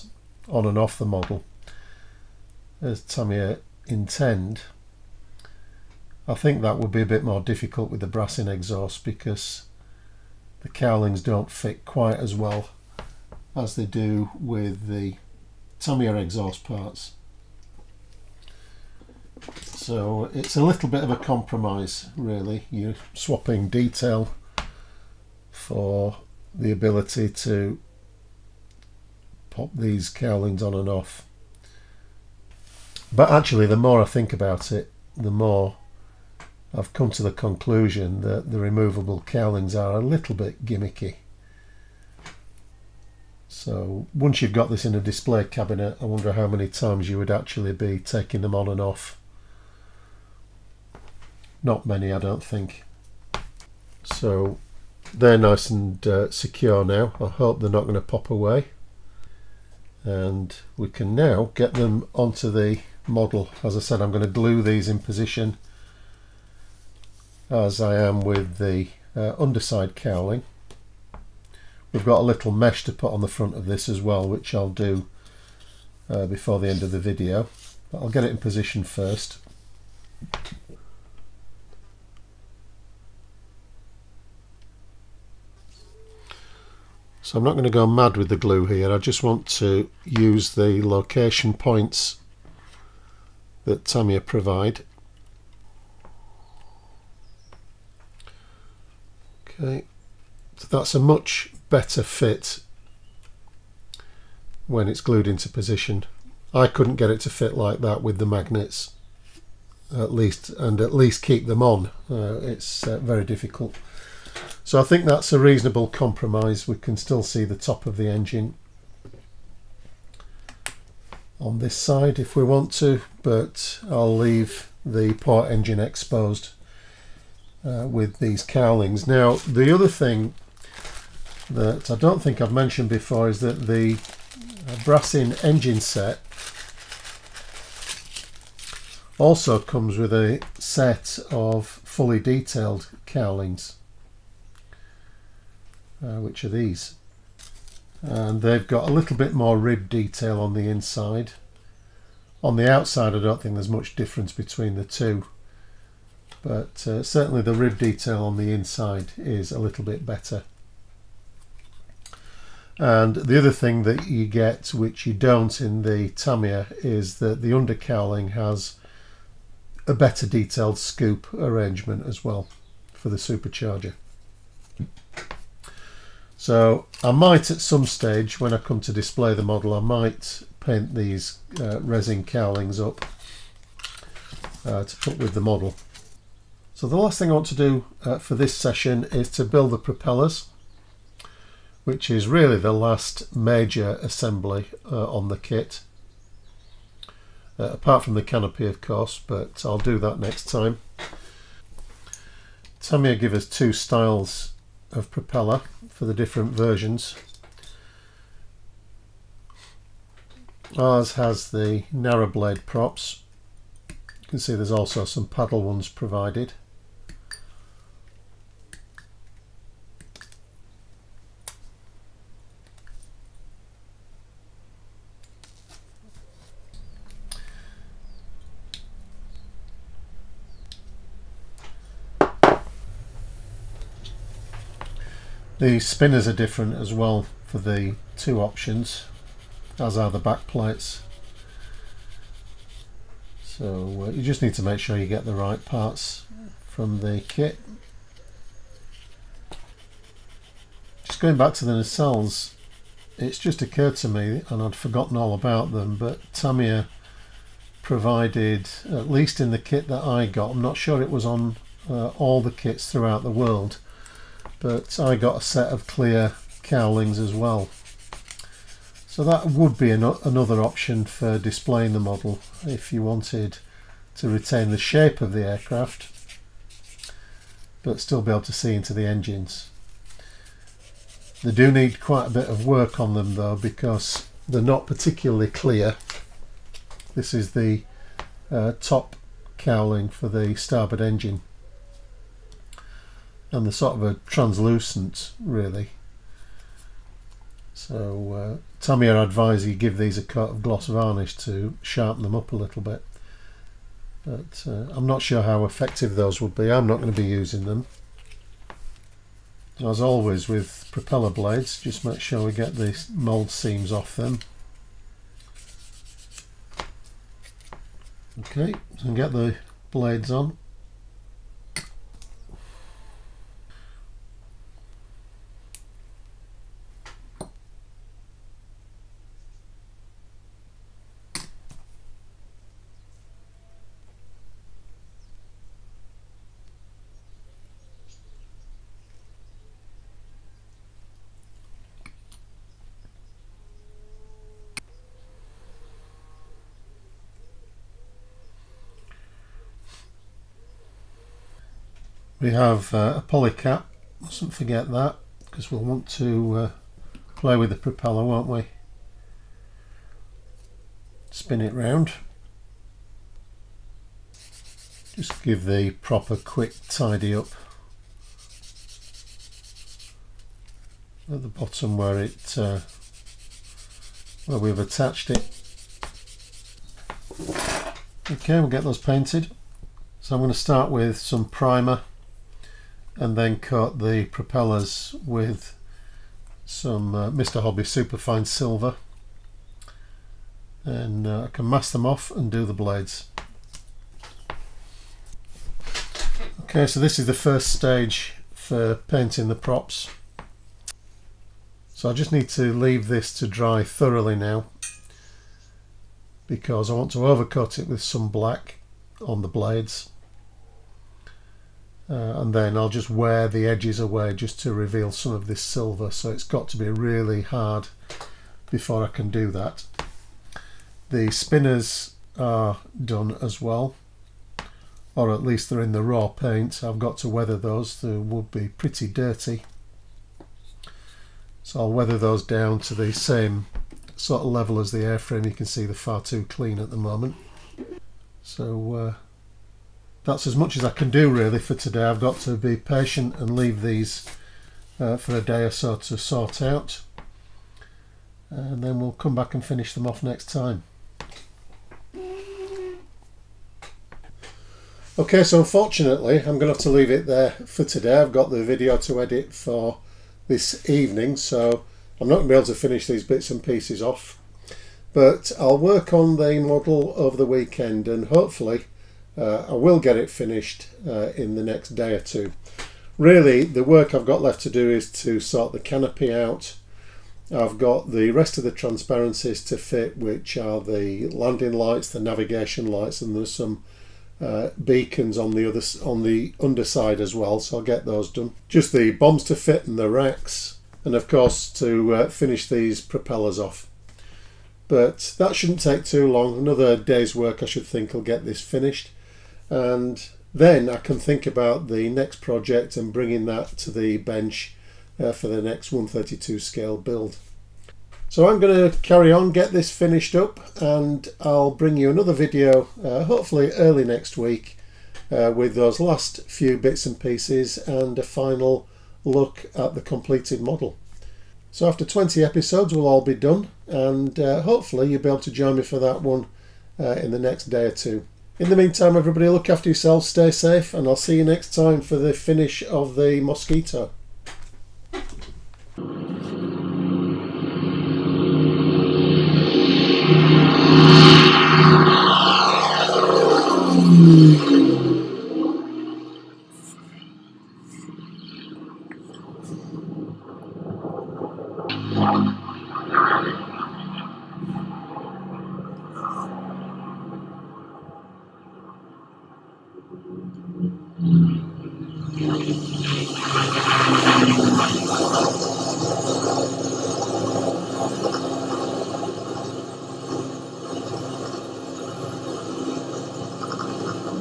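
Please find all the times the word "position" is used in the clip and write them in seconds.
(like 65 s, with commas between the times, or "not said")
64 s, 78 s, 105 s.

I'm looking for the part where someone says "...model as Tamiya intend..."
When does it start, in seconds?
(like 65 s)
1 s.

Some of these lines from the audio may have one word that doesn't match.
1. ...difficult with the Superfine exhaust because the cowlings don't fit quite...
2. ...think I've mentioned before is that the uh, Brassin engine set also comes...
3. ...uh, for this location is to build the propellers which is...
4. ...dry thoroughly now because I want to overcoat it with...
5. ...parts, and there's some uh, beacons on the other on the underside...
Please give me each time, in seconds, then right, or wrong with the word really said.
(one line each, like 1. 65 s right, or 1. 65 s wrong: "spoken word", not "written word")
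1. 7 s wrong: "Brassin", not "Superfine"
2. 132 s right
3. 188 s wrong: "session", not "location"
4. 403 s right
5. 482 s wrong: "lights", not "parts".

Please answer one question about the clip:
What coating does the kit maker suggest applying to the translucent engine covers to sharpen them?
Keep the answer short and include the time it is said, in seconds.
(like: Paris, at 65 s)
Gloss varnish, at 300 s.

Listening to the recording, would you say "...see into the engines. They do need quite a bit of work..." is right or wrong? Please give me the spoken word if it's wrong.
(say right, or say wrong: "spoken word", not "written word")
right.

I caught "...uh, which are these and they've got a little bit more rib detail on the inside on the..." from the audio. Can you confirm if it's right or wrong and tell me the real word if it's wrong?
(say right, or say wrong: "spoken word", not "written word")
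right.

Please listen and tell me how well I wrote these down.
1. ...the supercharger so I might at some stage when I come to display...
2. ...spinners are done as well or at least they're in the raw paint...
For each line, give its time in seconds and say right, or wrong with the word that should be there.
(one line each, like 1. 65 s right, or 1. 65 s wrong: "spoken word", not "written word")
1. 173 s right
2. 421 s right.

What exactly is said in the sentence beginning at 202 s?
Tamiya give us two styles of propeller for the different versions.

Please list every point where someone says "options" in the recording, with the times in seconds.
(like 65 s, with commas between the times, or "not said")
238 s, 270 s.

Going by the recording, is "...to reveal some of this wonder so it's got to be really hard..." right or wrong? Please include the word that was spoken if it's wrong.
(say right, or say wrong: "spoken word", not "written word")
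wrong: "silver", not "wonder".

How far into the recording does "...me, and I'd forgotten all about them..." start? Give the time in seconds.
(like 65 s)
254 s.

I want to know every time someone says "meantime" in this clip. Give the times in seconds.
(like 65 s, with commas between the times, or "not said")
528 s.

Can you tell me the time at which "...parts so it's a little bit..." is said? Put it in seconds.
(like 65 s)
16 s.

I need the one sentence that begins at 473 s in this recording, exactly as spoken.
Really, the work I've got left to do is to sort the canopy out.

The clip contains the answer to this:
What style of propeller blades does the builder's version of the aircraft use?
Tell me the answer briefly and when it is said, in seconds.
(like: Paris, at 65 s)
Narrow blade, at 211 s.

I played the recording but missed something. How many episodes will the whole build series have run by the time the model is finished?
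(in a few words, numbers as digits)
20.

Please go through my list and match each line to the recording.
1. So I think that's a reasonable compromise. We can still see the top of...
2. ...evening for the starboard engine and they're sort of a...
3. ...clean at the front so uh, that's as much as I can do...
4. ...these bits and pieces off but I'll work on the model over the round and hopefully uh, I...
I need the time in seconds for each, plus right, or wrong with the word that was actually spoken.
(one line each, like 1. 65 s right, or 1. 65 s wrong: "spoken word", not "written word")
1. 114 s right
2. 289 s wrong: "cowling", not "evening"
3. 436 s wrong: "moment", not "front"
4. 463 s wrong: "weekend", not "round".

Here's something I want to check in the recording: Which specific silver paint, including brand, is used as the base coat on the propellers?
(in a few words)
Mr. Hobby Superfine Silver.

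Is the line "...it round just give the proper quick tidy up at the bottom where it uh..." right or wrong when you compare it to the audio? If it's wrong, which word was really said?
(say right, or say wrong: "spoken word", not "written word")
right.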